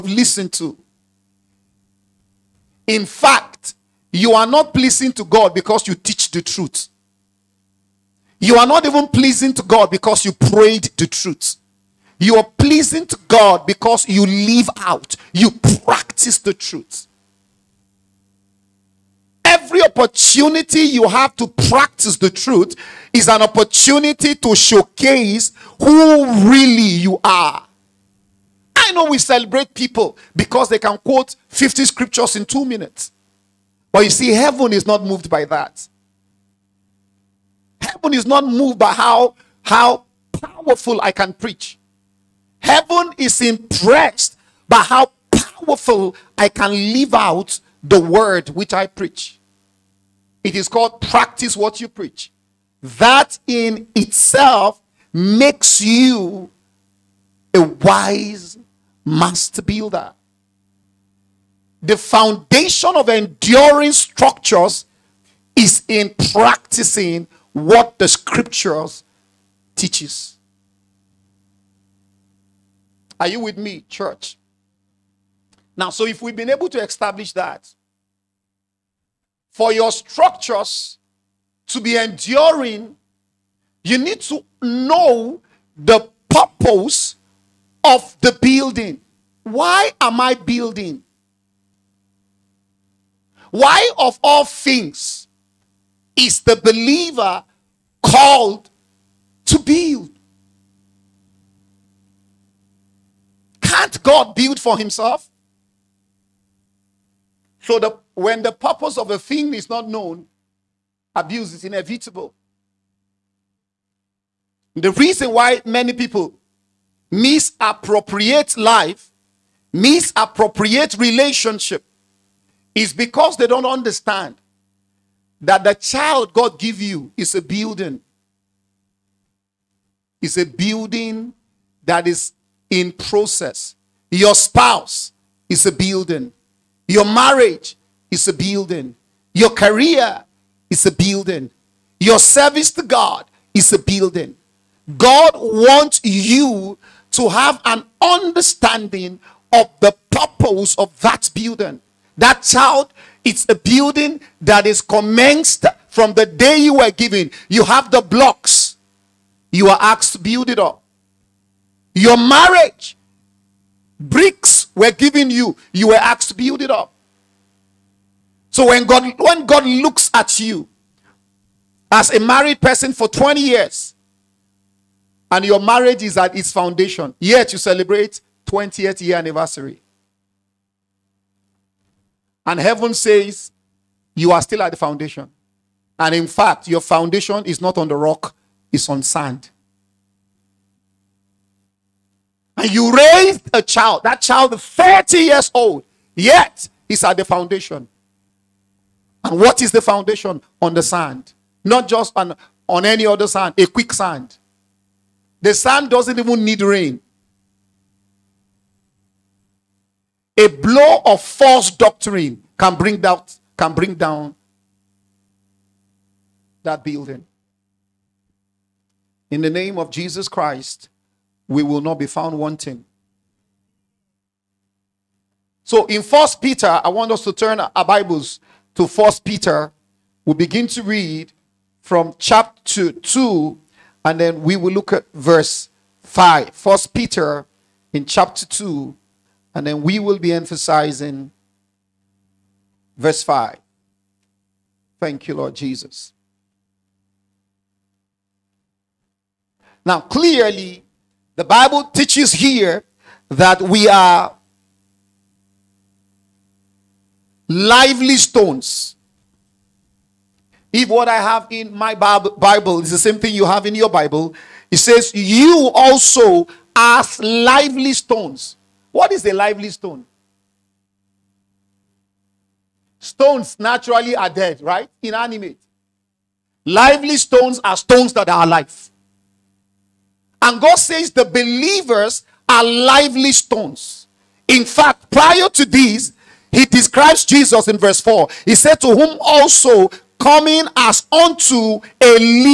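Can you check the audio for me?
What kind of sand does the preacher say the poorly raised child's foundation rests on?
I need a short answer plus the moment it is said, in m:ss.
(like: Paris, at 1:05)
quicksand, at 3:23.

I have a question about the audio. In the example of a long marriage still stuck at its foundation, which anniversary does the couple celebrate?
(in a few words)
20th.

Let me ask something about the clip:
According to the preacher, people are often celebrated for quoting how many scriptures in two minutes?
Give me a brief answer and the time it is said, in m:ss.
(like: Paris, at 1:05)
50, at 0:31.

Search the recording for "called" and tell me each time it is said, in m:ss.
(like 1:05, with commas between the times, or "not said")
0:50, 1:38.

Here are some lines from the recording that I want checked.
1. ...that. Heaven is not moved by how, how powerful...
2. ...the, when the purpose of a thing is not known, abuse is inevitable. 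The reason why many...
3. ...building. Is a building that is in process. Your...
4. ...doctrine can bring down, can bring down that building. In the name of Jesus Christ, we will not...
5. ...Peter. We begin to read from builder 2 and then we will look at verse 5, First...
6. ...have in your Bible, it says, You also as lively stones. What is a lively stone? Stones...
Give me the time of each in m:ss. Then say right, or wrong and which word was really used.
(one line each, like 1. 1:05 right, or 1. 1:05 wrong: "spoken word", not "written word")
1. 0:35 right
2. 1:47 right
3. 2:07 right
4. 3:31 right
5. 3:49 wrong: "chapter", not "builder"
6. 4:23 right.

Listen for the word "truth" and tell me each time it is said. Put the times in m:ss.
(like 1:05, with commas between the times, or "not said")
0:06, 0:11, 0:16, 0:22.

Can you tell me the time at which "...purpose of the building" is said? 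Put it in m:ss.
1:26.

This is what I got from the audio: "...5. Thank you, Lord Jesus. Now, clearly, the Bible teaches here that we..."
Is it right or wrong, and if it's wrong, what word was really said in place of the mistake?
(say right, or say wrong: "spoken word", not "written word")
right.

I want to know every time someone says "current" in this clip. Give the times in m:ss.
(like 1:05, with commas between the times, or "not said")
not said.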